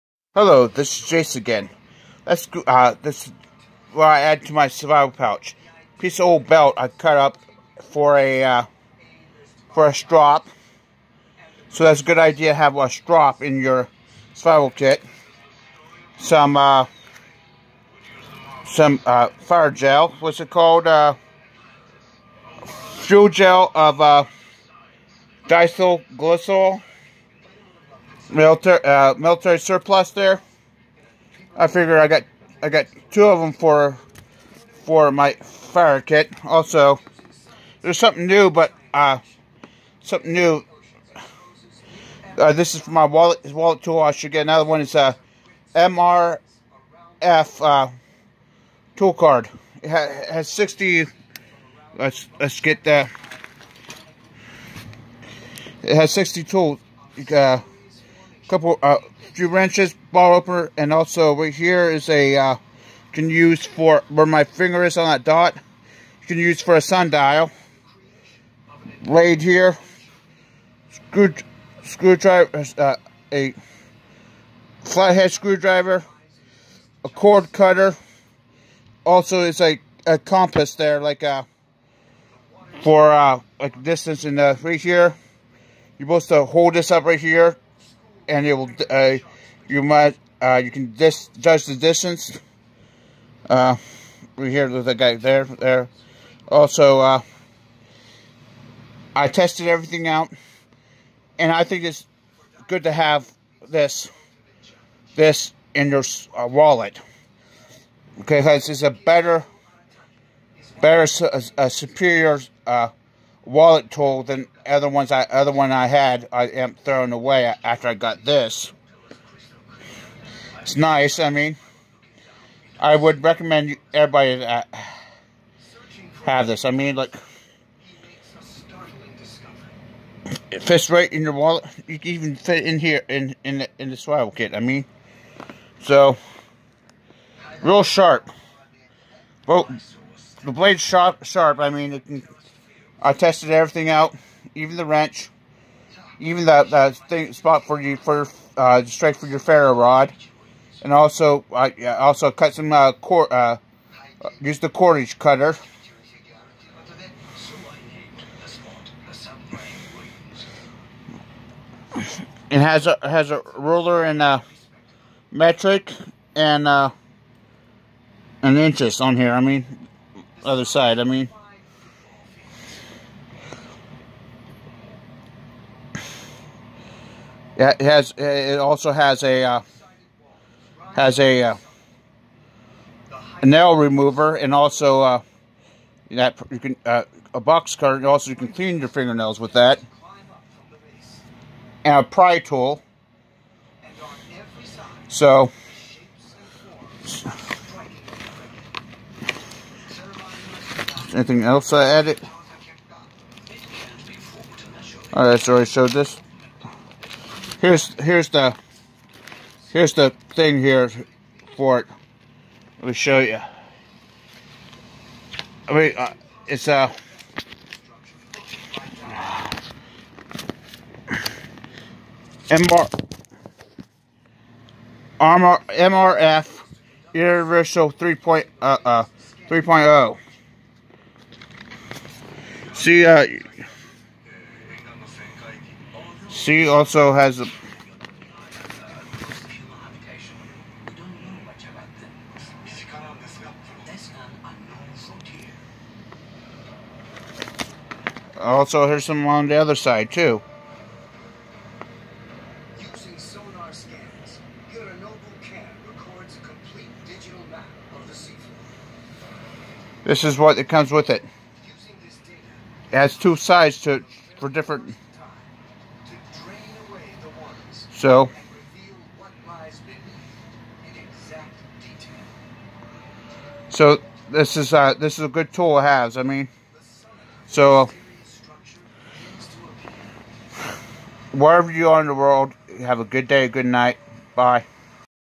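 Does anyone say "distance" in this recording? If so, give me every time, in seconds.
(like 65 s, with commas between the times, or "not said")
83 s, 91 s.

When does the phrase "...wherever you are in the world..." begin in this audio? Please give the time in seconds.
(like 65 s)
281 s.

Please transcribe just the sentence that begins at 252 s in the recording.
Using sonar scans, records a complete digital map of the seafloor.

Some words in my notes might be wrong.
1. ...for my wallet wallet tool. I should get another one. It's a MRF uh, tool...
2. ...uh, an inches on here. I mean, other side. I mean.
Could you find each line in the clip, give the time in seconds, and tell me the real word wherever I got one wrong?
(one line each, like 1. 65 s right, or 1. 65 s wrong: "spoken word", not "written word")
1. 42 s right
2. 166 s right.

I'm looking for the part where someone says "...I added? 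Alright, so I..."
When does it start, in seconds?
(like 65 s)
201 s.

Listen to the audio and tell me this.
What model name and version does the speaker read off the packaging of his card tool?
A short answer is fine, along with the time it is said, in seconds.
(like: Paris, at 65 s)
MRF Universal 3.0, at 225 s.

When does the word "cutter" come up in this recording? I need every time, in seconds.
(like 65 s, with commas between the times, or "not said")
77 s, 155 s, 187 s.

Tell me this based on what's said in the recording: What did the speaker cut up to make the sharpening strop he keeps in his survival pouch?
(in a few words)
Old belt.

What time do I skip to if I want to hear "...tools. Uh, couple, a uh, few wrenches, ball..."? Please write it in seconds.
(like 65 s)
56 s.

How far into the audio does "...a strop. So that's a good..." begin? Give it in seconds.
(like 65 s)
9 s.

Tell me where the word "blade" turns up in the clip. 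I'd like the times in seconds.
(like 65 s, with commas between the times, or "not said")
69 s, 140 s.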